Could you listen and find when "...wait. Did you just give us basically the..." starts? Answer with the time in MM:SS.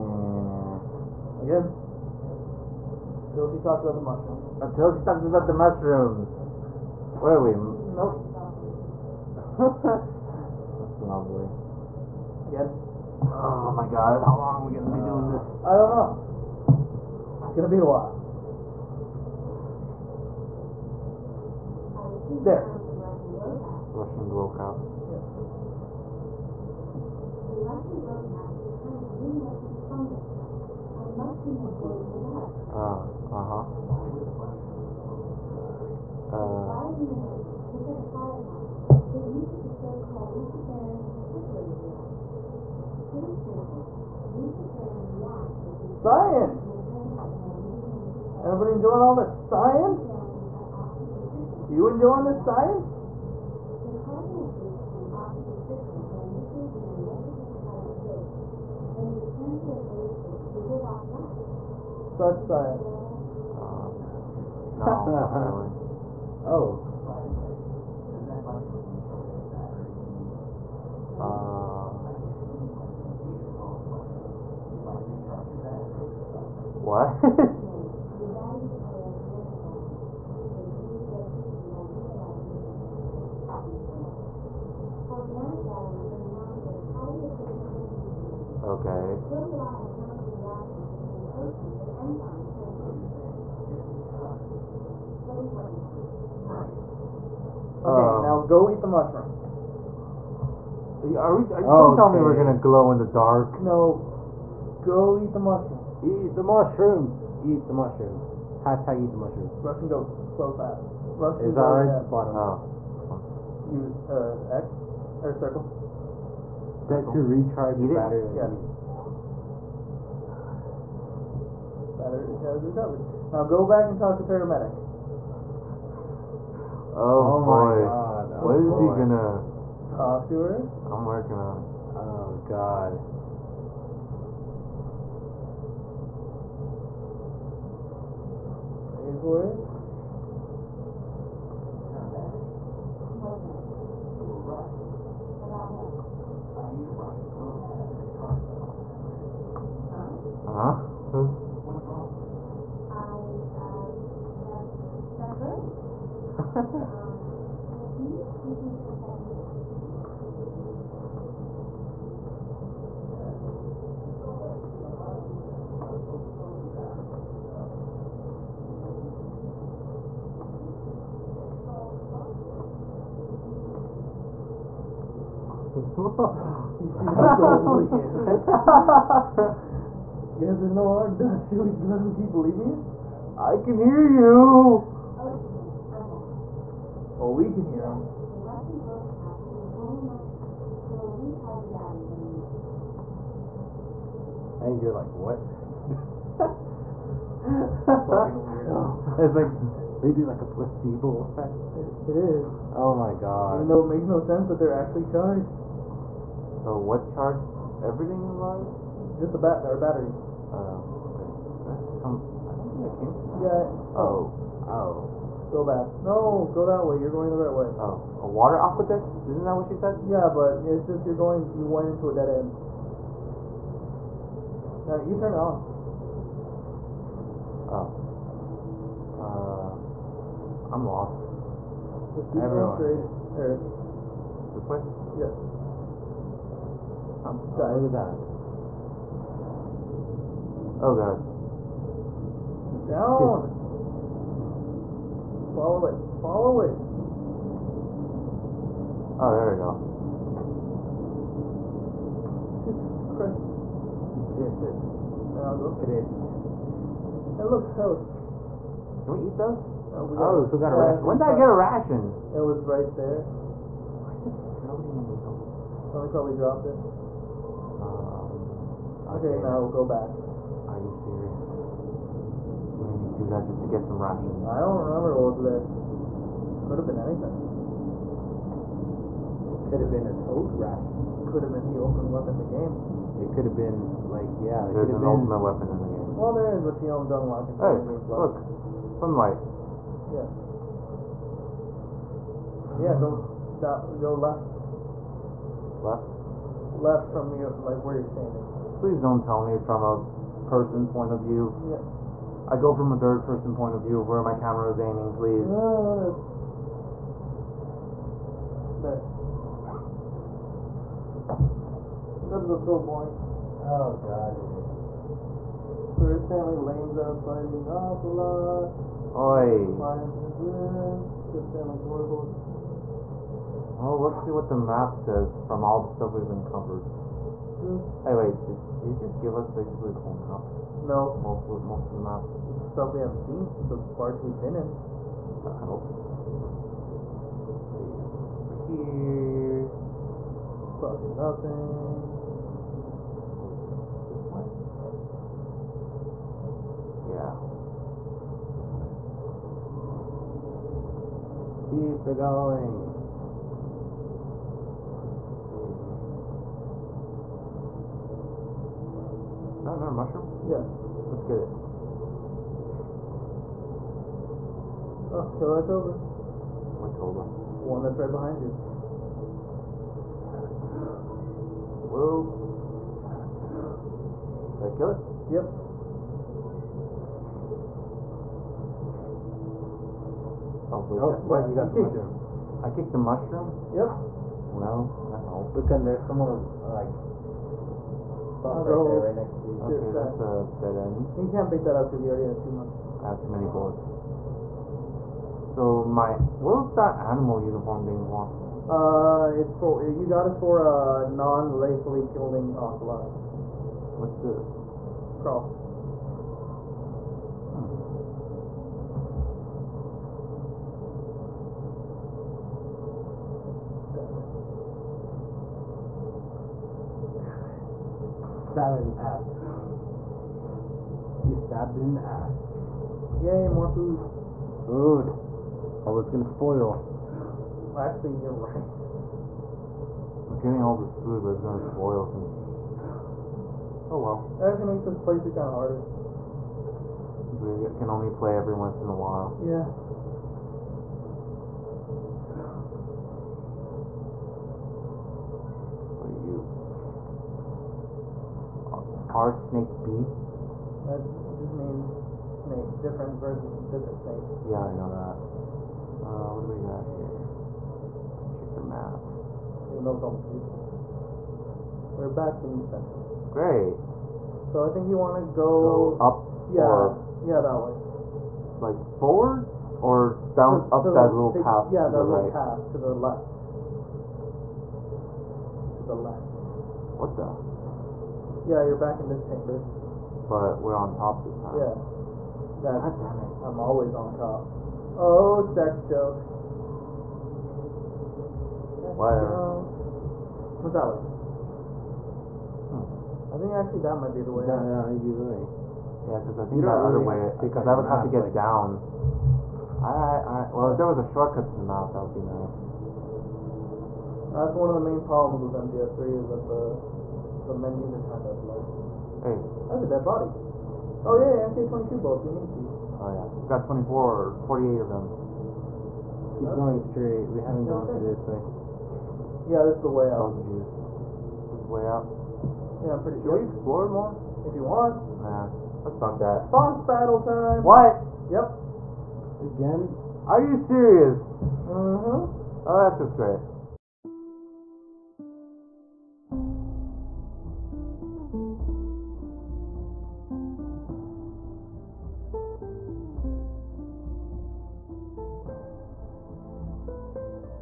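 05:28.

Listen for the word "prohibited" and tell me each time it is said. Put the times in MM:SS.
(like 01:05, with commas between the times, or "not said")
not said.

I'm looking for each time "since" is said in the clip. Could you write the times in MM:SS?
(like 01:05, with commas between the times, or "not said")
07:12, 07:17.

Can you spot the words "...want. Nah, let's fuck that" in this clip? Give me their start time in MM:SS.
08:44.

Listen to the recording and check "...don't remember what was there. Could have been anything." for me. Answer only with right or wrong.
right.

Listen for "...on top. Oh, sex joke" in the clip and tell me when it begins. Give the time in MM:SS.
08:03.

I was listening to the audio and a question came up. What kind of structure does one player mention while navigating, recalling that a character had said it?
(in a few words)
A water aqueduct.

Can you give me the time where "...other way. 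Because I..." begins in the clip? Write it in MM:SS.
08:17.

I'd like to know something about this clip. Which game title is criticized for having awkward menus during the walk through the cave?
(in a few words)
MGS3.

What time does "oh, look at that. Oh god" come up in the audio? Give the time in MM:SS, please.
03:57.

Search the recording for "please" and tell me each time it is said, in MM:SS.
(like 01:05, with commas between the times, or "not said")
04:58, 05:05.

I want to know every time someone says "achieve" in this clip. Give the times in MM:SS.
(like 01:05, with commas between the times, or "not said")
not said.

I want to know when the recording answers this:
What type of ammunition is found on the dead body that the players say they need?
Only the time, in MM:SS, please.
08:31.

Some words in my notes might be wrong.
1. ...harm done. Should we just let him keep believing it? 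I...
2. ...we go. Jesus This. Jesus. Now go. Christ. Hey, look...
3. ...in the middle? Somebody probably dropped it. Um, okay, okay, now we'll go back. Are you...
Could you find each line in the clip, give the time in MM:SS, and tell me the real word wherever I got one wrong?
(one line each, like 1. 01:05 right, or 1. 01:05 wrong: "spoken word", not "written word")
1. 03:00 right
2. 04:09 wrong: "Christ", not "This"
3. 04:24 right.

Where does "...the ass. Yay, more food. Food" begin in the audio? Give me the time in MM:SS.
07:01.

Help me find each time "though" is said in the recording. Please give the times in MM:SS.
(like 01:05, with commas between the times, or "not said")
03:23, 07:39.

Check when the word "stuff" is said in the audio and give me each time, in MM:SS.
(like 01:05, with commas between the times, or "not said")
05:25, 05:32, 06:28.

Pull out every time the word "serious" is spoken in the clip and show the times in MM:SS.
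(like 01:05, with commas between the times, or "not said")
04:30, 08:50.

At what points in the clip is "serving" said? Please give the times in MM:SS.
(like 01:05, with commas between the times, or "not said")
not said.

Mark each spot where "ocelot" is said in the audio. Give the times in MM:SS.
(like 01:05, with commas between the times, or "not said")
05:17, 06:42.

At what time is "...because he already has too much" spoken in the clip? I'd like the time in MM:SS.
06:31.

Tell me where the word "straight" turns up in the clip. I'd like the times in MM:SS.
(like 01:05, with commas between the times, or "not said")
03:53, 08:36.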